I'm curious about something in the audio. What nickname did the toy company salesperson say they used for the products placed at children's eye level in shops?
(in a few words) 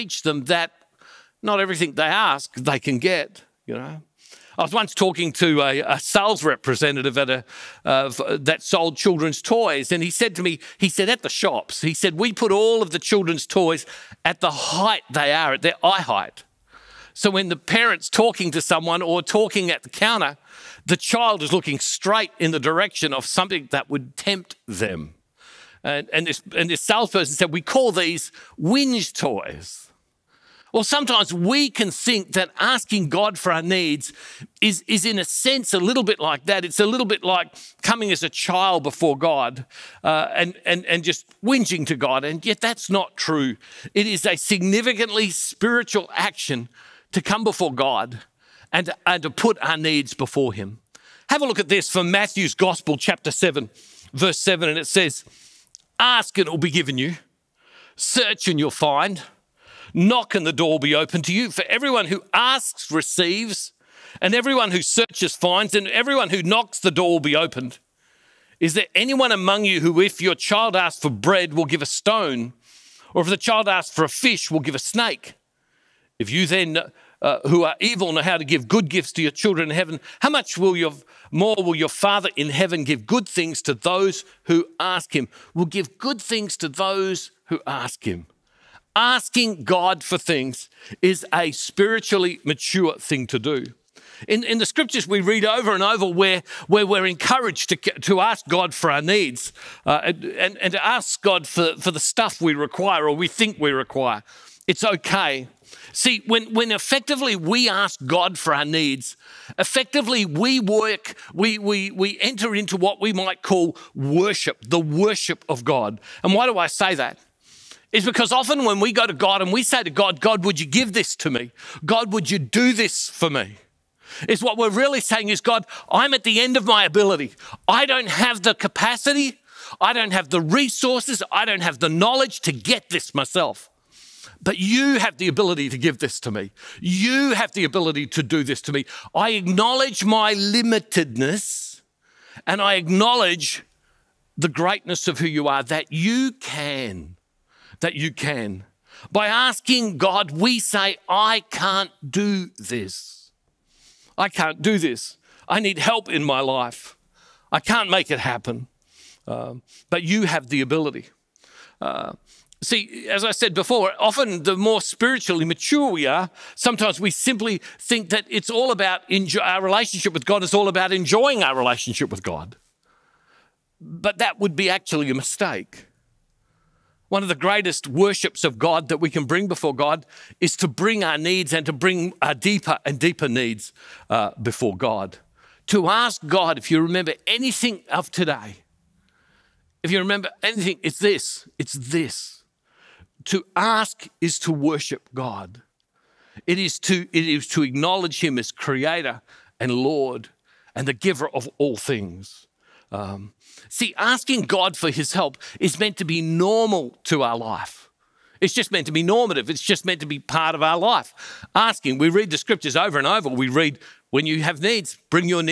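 whinge toys.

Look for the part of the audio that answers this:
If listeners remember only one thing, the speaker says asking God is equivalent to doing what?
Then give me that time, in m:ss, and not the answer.
3:14.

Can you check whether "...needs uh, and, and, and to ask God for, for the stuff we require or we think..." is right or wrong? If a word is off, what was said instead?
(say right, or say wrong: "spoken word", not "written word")
right.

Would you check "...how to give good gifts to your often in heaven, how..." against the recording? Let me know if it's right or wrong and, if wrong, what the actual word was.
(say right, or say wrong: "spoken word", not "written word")
wrong: "children", not "often".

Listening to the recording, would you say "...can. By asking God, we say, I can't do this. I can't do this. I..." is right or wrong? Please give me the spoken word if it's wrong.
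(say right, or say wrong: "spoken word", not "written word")
right.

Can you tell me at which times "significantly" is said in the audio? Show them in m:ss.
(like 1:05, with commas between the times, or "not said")
0:44.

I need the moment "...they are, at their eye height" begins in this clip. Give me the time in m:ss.
0:15.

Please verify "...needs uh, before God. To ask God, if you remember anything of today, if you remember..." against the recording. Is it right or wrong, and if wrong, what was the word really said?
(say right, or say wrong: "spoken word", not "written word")
right.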